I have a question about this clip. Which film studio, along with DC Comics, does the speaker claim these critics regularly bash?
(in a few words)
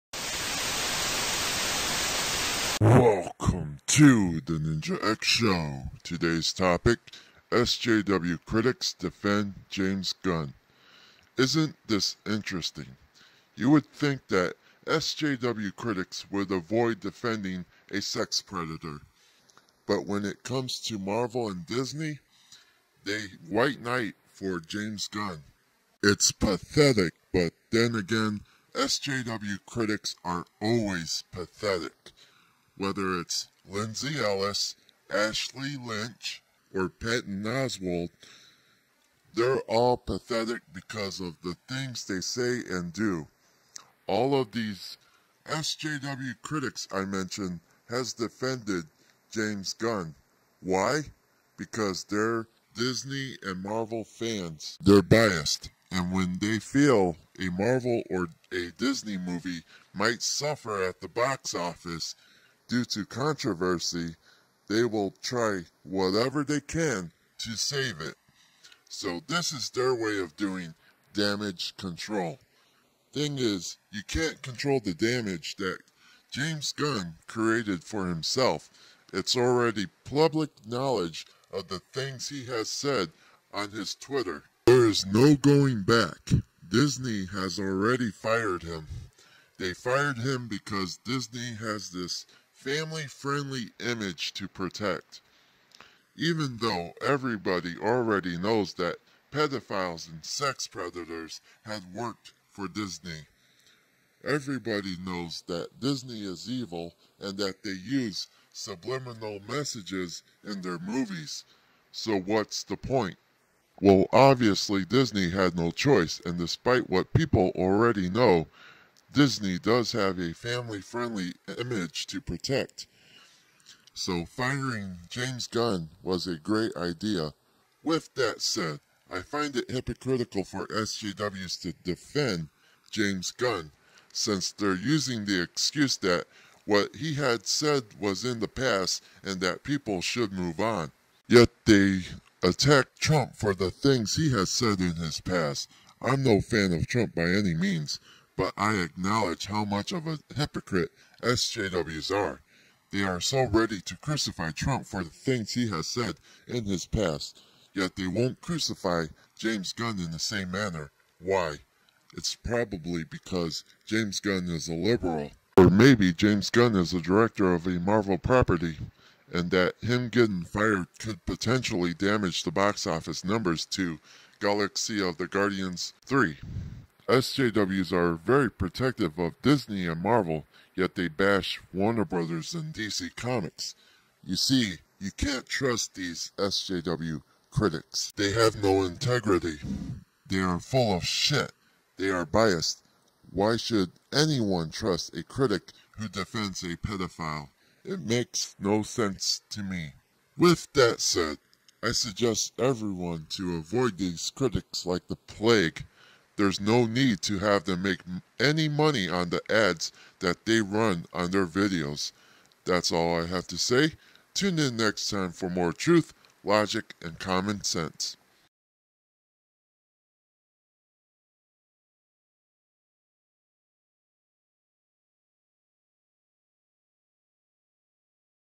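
Warner Brothers.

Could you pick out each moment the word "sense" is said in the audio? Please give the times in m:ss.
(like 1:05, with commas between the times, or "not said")
3:18, 3:37.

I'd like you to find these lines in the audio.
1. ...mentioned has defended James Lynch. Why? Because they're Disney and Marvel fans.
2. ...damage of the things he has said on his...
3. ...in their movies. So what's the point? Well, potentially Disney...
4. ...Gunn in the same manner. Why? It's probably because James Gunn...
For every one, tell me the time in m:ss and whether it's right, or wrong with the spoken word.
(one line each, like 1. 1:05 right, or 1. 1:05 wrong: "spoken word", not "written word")
1. 0:47 wrong: "Gunn", not "Lynch"
2. 1:20 wrong: "knowledge", not "damage"
3. 1:50 wrong: "obviously", not "potentially"
4. 2:39 right.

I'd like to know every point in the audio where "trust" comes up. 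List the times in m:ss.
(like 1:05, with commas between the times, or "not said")
3:05, 3:14.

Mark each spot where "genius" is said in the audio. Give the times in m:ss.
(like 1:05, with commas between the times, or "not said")
not said.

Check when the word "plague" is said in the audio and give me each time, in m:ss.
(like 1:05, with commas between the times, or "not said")
3:25.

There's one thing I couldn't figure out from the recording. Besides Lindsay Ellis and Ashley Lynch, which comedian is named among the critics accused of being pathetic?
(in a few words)
Patton Oswalt.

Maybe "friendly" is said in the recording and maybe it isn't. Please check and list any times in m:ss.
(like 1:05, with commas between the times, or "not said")
1:33, 2:00.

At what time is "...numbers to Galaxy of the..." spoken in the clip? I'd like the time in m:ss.
2:53.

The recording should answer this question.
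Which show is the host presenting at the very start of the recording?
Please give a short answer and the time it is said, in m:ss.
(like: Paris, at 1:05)
Ninja X Show, at 0:04.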